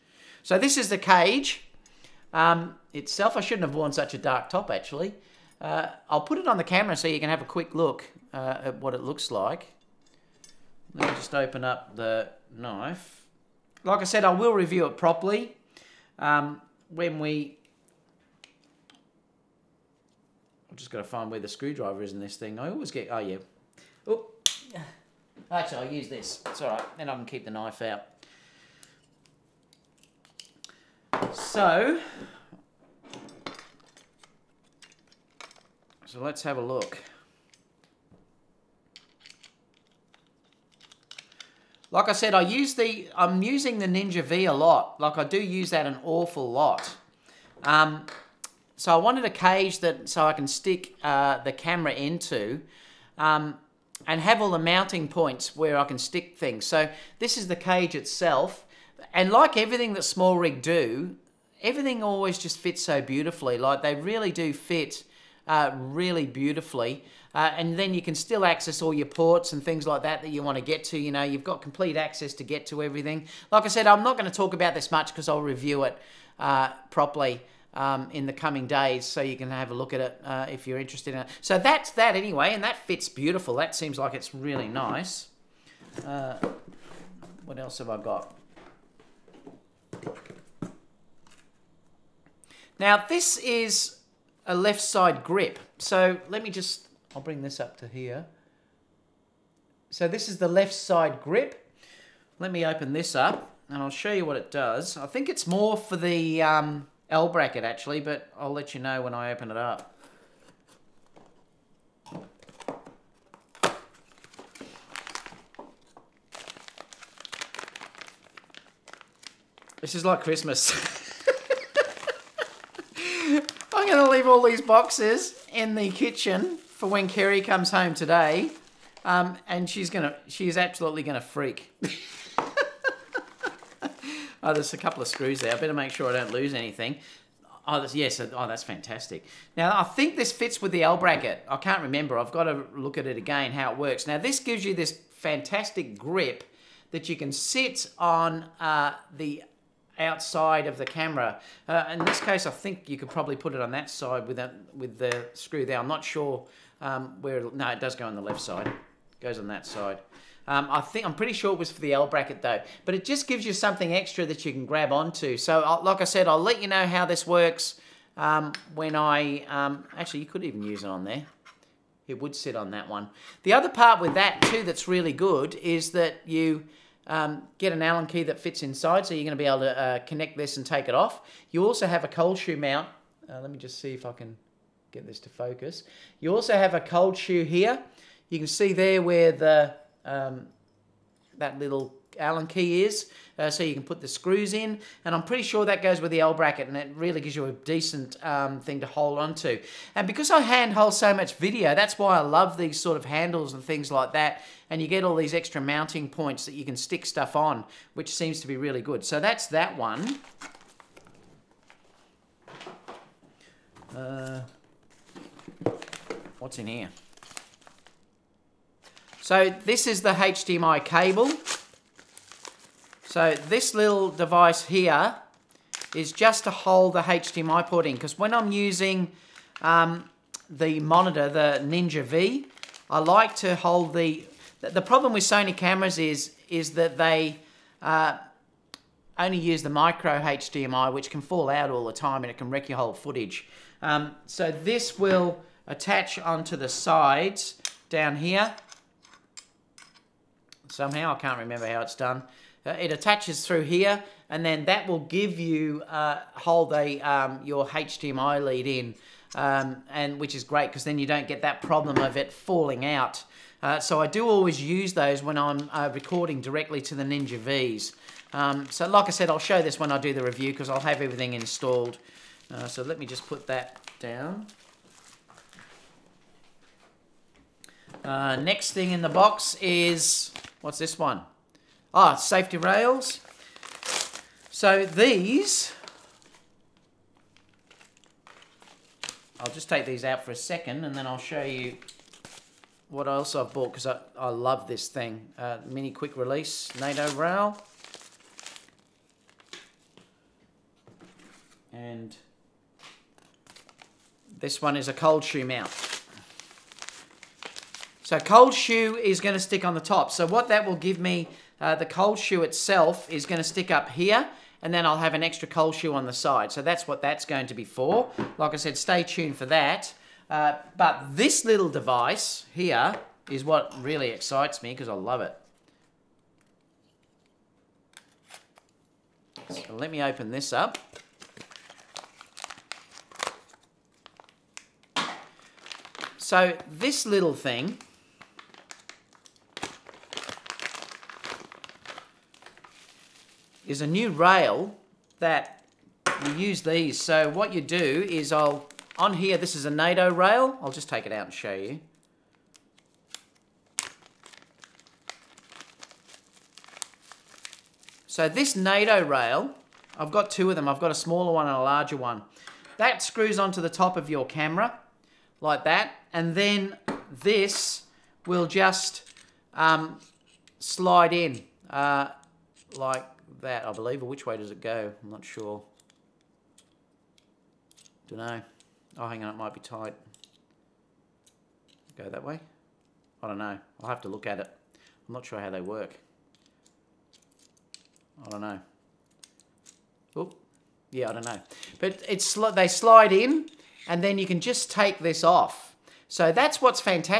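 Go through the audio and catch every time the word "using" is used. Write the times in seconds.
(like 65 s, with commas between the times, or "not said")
43 s, 228 s.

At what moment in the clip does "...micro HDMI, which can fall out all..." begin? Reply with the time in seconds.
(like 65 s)
239 s.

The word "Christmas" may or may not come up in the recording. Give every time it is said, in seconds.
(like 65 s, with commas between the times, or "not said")
120 s.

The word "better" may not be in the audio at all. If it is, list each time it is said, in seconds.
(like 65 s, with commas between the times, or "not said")
135 s.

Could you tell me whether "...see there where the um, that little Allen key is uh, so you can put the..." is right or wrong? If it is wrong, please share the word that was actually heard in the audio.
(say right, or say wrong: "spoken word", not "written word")
right.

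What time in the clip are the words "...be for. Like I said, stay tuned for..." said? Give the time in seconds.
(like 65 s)
317 s.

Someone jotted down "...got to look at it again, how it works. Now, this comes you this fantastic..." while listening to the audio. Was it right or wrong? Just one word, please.
wrong.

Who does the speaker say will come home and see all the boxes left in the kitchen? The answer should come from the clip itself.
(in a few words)
Kerry.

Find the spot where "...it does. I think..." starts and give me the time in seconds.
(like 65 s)
104 s.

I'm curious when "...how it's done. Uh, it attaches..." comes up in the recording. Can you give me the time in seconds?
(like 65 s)
251 s.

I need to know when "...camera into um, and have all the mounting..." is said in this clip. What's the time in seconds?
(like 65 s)
51 s.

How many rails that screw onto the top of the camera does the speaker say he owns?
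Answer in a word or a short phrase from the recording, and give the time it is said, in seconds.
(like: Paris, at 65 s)
2, at 360 s.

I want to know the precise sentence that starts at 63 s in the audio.
Like they really do fit uh, really beautifully.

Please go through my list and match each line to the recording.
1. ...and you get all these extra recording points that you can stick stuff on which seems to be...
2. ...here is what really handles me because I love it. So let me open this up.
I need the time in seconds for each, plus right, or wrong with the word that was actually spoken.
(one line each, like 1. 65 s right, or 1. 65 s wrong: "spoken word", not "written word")
1. 204 s wrong: "mounting", not "recording"
2. 322 s wrong: "excites", not "handles".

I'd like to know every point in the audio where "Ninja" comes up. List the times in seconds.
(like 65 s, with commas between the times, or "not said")
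43 s, 231 s, 267 s.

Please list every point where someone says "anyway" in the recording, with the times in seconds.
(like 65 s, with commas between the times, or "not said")
82 s.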